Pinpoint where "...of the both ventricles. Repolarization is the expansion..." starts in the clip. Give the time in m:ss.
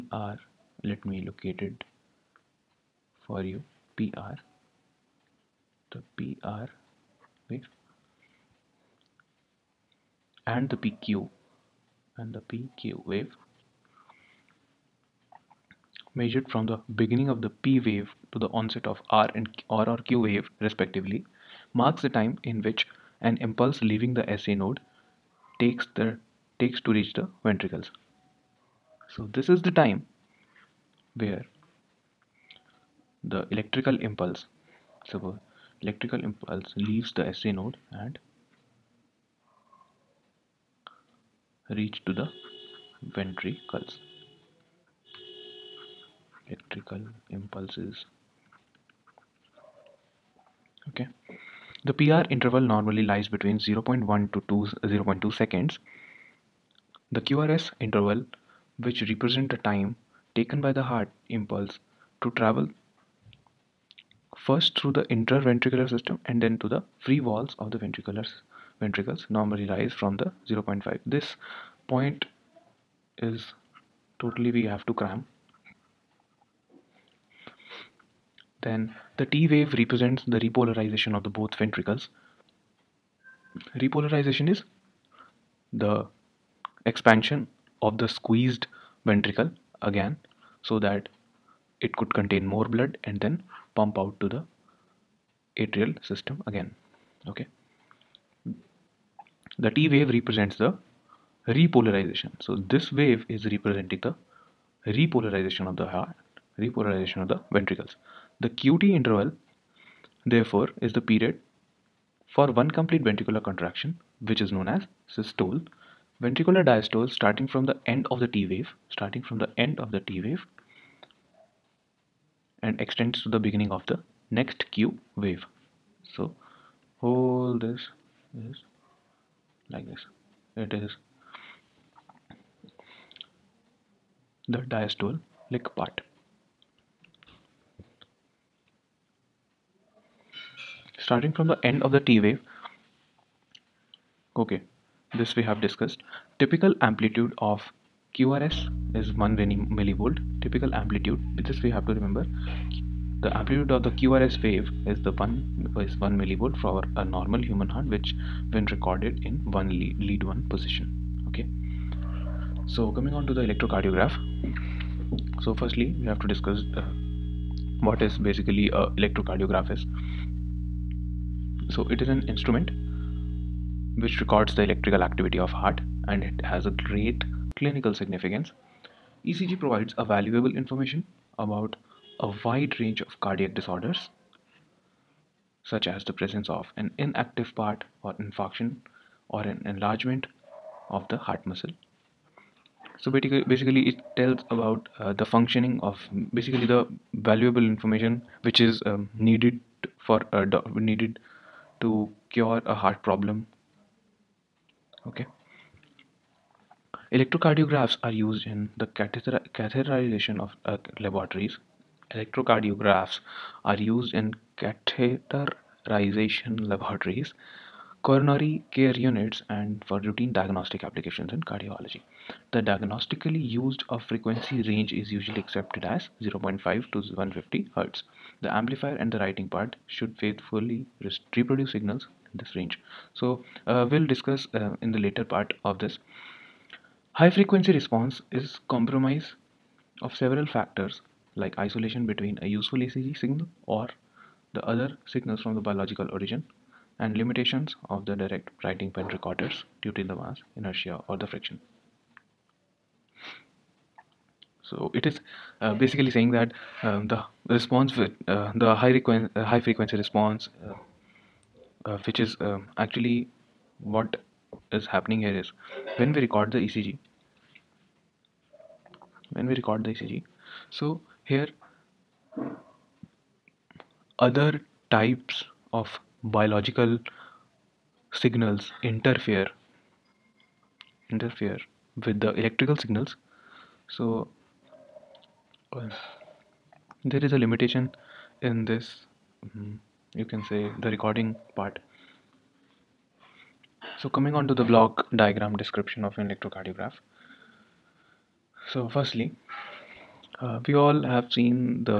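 1:21.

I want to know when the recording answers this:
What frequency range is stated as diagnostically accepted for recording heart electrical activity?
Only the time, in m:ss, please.
3:46.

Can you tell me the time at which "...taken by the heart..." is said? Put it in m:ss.
1:00.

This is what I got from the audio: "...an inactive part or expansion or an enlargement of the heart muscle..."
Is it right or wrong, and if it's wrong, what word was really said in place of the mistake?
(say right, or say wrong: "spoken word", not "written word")
wrong: "infarction", not "expansion".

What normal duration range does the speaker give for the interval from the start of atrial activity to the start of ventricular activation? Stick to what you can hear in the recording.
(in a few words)
0.1 to 0.2 seconds.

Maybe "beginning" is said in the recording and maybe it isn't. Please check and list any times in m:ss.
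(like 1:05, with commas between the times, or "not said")
0:17, 2:03.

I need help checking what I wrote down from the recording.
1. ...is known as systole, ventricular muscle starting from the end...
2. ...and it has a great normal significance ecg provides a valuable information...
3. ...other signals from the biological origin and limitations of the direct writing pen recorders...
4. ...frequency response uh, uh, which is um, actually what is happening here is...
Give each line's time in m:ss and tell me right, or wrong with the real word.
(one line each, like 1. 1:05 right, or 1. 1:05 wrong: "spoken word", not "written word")
1. 1:54 wrong: "diastole", not "muscle"
2. 2:56 wrong: "clinical", not "normal"
3. 4:04 right
4. 4:19 right.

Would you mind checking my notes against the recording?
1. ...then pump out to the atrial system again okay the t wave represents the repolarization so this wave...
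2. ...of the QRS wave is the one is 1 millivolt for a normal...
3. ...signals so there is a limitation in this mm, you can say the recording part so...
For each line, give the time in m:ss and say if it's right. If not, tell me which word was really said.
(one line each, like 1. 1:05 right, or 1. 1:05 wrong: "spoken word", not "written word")
1. 1:33 right
2. 2:33 right
3. 4:42 right.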